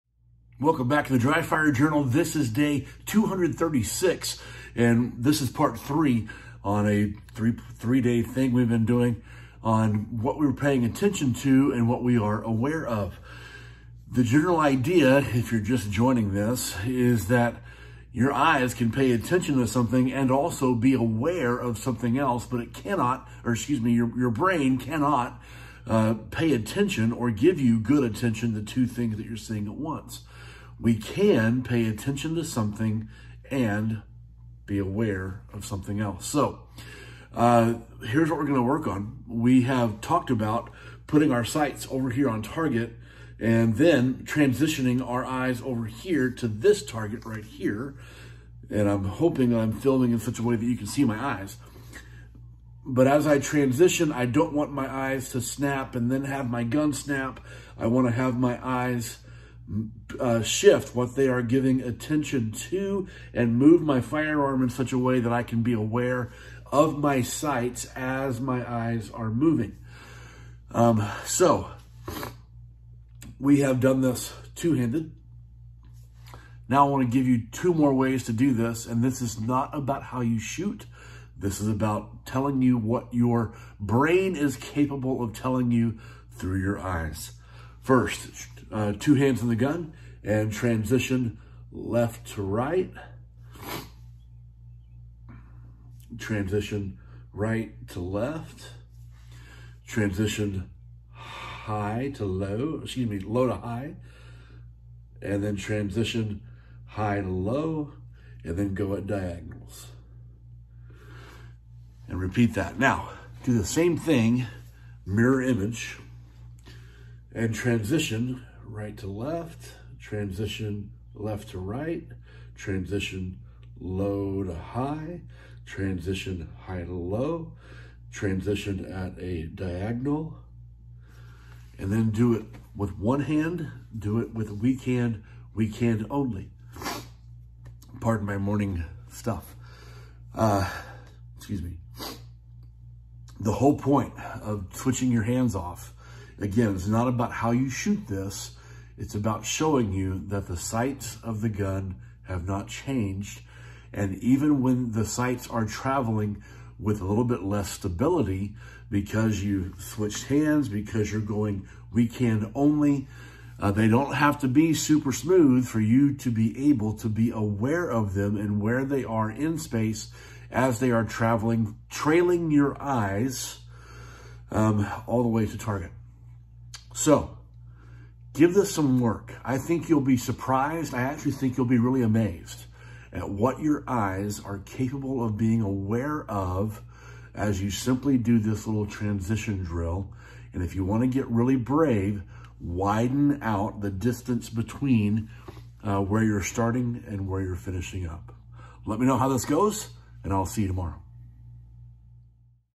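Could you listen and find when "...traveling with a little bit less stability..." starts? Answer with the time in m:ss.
2:35.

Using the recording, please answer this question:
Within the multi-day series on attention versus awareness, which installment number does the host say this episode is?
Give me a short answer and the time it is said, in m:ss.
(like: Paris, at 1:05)
Part three, at 0:05.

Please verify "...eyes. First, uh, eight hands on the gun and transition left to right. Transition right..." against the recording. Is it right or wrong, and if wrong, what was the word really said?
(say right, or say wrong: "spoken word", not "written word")
wrong: "two", not "eight".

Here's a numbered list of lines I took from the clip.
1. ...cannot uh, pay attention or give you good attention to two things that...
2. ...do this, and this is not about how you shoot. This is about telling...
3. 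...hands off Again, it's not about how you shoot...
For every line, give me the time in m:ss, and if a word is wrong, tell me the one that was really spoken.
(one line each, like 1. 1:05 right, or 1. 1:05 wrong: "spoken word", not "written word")
1. 0:24 right
2. 1:18 right
3. 2:25 right.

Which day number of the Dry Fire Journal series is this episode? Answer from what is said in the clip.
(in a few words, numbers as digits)
236.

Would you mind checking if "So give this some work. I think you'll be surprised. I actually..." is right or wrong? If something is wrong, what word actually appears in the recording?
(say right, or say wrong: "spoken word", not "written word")
right.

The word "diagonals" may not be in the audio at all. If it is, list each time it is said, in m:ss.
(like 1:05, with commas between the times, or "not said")
1:49, 2:09.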